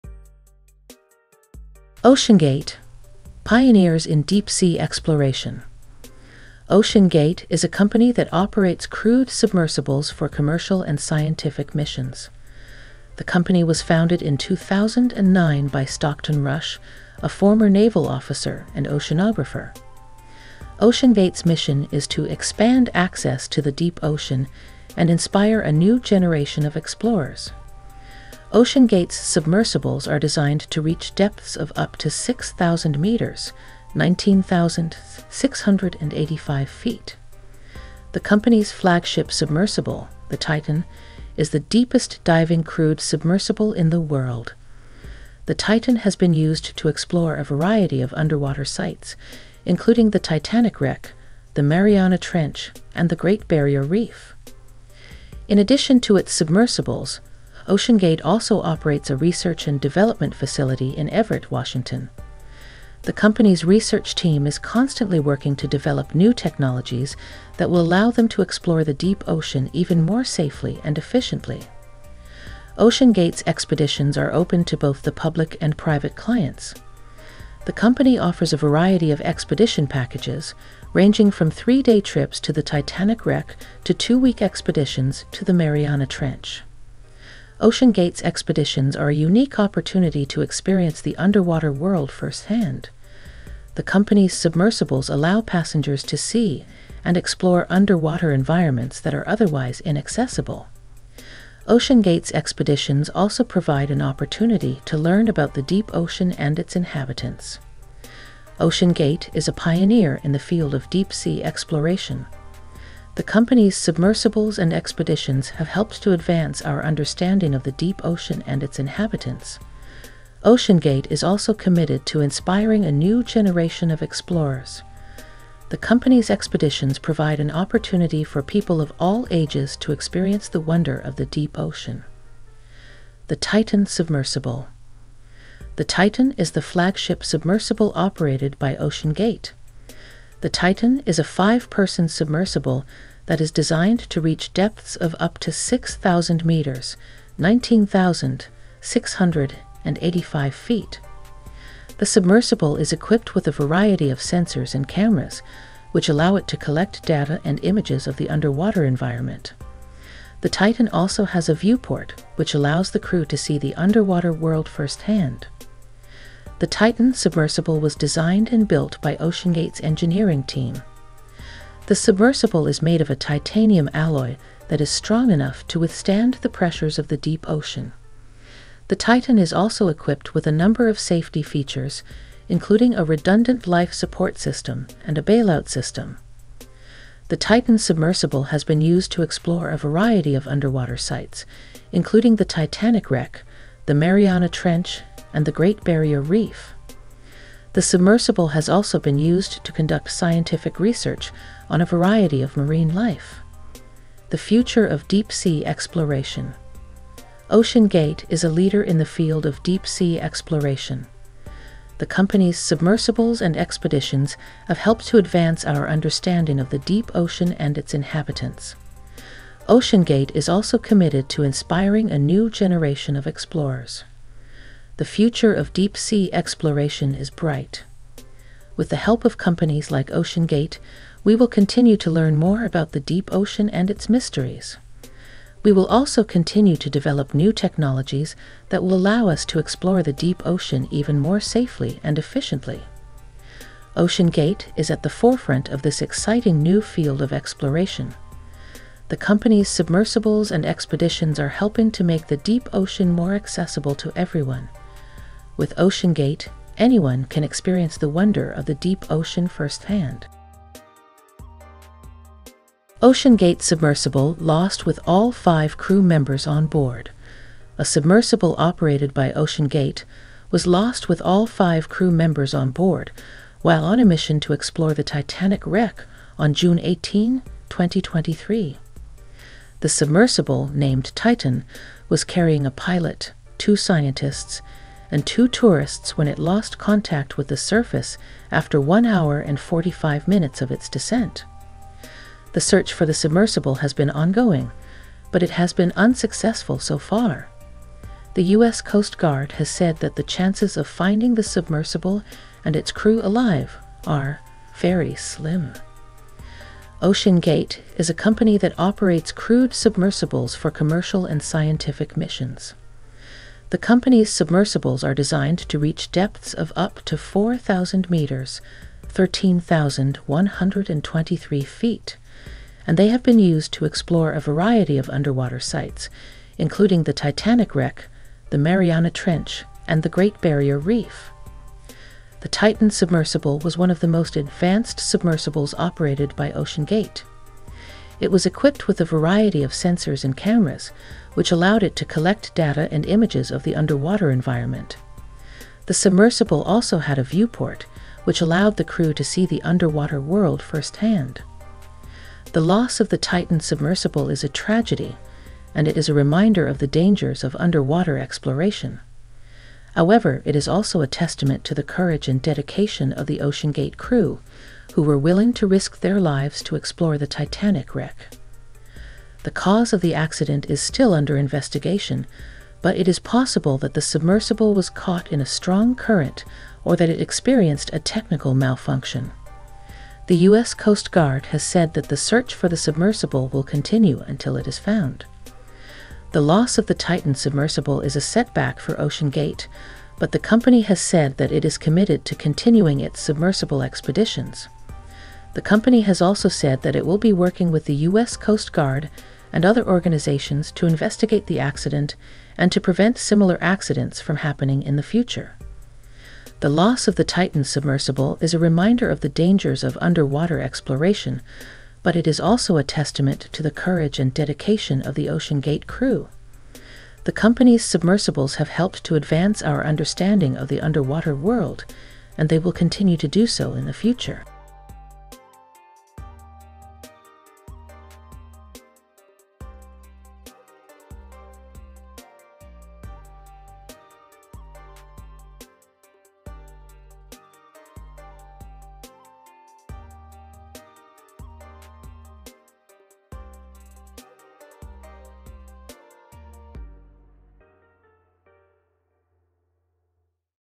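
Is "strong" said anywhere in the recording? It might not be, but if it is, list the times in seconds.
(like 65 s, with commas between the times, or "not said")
174 s, 375 s.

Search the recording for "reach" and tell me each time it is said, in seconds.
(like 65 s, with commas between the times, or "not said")
30 s, 144 s, 315 s.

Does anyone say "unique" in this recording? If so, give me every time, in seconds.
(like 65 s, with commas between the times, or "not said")
89 s.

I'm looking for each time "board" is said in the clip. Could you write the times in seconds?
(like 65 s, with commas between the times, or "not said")
266 s, 272 s.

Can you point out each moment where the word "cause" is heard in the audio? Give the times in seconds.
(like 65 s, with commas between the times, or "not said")
369 s.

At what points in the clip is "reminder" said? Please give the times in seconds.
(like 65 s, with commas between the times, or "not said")
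356 s, 408 s.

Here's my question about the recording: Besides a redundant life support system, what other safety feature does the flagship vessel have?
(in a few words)
a bailout system.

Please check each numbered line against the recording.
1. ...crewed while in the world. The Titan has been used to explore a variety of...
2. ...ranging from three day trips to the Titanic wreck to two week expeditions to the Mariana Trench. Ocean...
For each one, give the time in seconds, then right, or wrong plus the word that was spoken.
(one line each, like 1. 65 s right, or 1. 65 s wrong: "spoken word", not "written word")
1. 42 s wrong: "submersible", not "while"
2. 80 s right.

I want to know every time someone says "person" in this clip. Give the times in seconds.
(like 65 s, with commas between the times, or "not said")
141 s.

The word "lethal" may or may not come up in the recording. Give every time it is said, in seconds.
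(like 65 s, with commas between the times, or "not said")
not said.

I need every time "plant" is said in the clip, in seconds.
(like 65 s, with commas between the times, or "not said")
not said.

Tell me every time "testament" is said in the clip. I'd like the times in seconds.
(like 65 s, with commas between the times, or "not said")
361 s, 412 s.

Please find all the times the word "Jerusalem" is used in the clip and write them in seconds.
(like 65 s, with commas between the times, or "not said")
not said.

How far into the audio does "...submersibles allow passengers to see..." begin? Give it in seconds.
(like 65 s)
94 s.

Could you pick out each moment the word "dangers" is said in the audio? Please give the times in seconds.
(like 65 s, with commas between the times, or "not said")
356 s, 409 s.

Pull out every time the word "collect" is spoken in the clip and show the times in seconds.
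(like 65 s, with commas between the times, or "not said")
156 s, 342 s.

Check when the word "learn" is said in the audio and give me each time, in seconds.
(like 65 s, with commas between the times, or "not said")
104 s, 232 s.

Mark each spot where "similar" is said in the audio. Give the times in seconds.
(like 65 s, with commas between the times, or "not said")
403 s.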